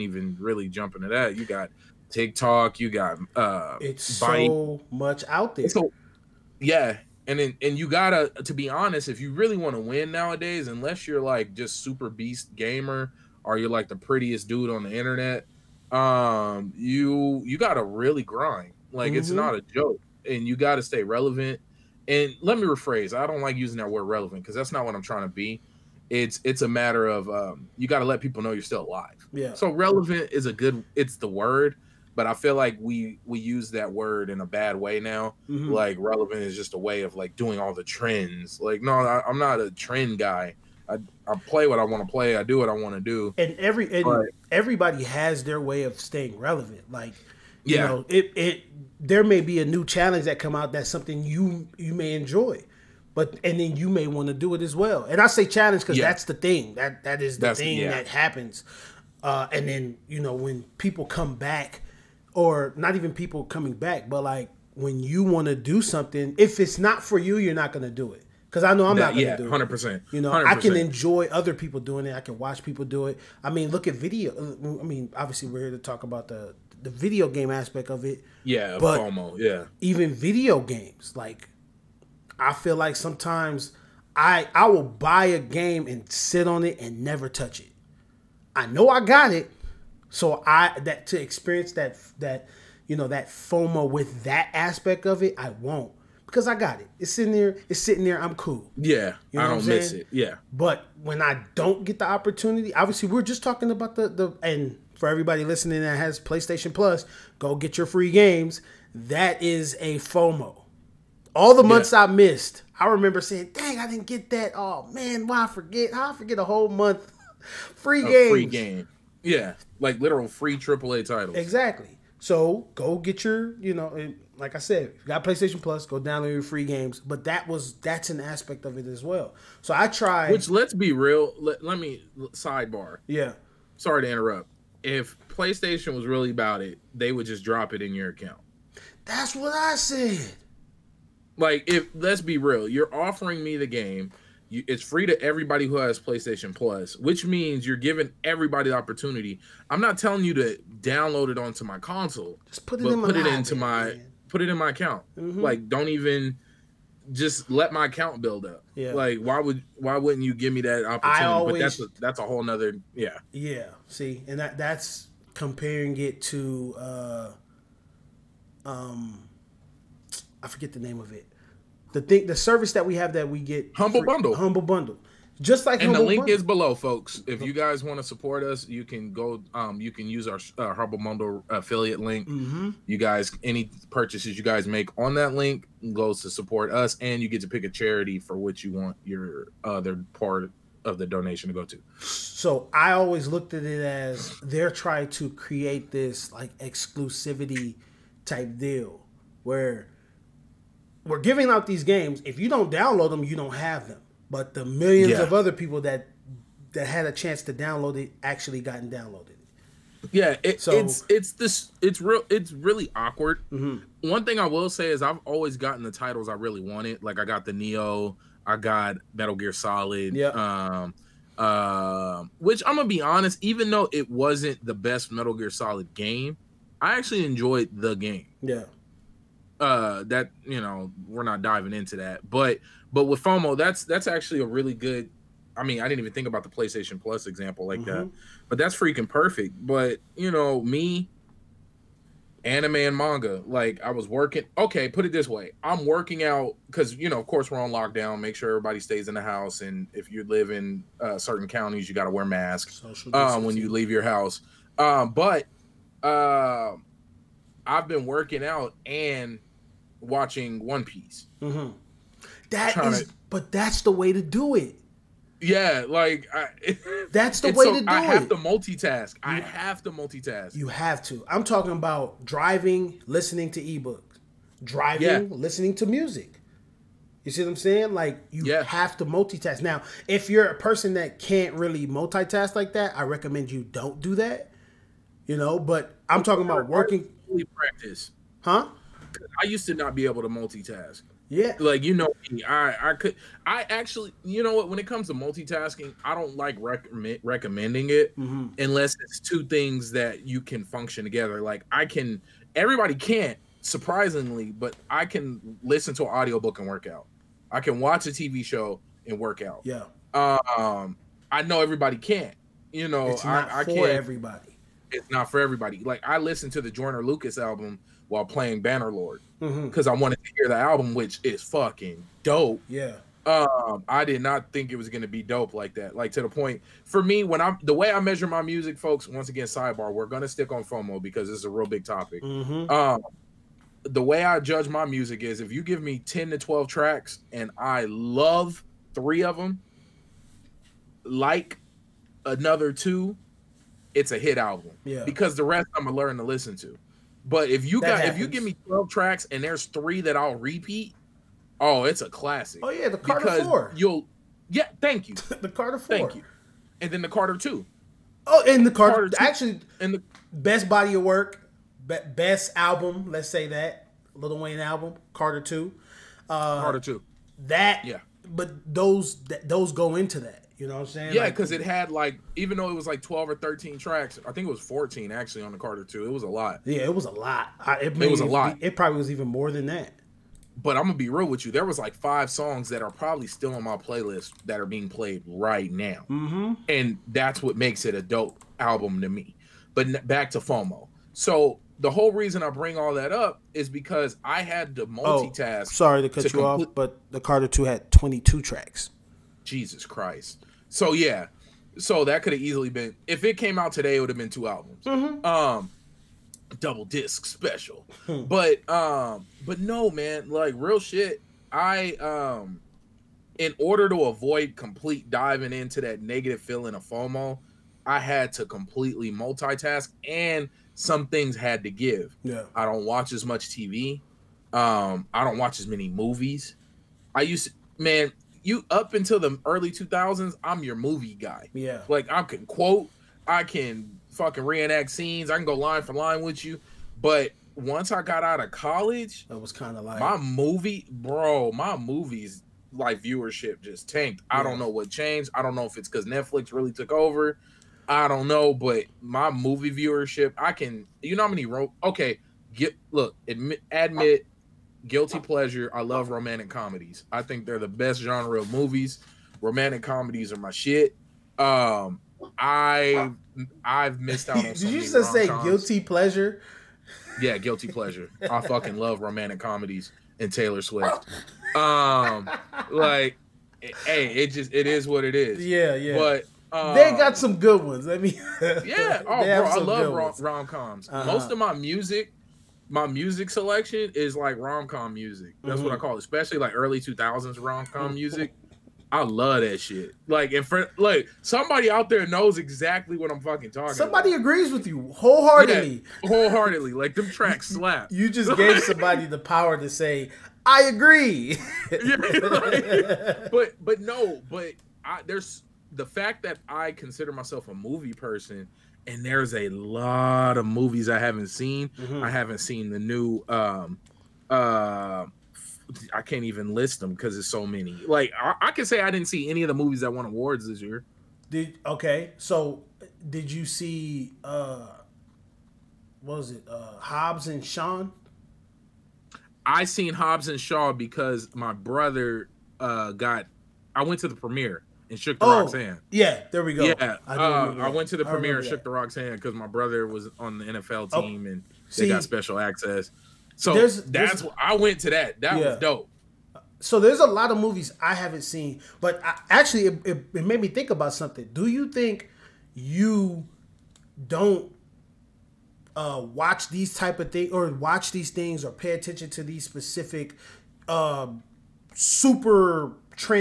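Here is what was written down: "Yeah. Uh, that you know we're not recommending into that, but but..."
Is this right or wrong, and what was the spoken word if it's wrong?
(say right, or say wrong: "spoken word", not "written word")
wrong: "diving", not "recommending".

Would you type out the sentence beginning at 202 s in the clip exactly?
If you don't download them, you don't have them but the millions yeah.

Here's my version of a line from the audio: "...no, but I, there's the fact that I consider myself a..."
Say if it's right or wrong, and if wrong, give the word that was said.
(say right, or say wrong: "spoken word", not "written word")
right.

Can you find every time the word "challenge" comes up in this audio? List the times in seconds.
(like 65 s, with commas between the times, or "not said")
49 s, 55 s.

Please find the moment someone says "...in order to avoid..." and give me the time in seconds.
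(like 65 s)
413 s.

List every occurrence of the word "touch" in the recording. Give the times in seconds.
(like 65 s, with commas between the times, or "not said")
87 s.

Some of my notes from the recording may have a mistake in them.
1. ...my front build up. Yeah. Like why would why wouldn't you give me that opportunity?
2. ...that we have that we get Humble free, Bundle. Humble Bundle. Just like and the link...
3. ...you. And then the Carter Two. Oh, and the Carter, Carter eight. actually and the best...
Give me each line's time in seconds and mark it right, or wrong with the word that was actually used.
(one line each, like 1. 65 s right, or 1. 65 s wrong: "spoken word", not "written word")
1. 157 s wrong: "account", not "front"
2. 172 s right
3. 356 s wrong: "two", not "eight".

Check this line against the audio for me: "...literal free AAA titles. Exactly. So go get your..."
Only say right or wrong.
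right.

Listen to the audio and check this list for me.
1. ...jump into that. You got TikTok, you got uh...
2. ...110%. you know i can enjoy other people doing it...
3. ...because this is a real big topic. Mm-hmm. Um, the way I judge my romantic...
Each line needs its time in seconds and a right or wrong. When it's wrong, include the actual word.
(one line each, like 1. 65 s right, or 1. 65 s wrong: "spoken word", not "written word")
1. 0 s right
2. 69 s wrong: "100", not "110"
3. 331 s wrong: "music", not "romantic".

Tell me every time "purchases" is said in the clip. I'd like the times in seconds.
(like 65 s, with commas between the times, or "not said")
183 s.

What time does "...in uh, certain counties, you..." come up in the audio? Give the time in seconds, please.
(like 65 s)
250 s.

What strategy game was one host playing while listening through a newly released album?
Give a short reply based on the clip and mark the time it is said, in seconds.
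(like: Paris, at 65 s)
Bannerlord, at 318 s.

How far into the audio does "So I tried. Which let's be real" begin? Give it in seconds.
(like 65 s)
129 s.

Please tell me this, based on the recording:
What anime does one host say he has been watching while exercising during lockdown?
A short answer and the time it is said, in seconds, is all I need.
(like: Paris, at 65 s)
One Piece, at 260 s.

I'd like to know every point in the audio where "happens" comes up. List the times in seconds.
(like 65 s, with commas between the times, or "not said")
58 s, 347 s.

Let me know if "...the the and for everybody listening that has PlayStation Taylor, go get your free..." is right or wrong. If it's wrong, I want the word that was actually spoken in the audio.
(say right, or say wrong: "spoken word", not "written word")
wrong: "Plus", not "Taylor".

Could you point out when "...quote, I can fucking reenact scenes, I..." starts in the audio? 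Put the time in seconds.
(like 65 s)
432 s.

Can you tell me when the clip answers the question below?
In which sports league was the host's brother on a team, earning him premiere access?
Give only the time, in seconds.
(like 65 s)
540 s.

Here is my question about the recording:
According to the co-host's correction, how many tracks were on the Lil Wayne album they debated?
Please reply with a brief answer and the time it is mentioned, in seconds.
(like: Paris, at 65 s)
22, at 397 s.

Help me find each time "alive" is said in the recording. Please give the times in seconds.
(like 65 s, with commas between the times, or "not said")
28 s.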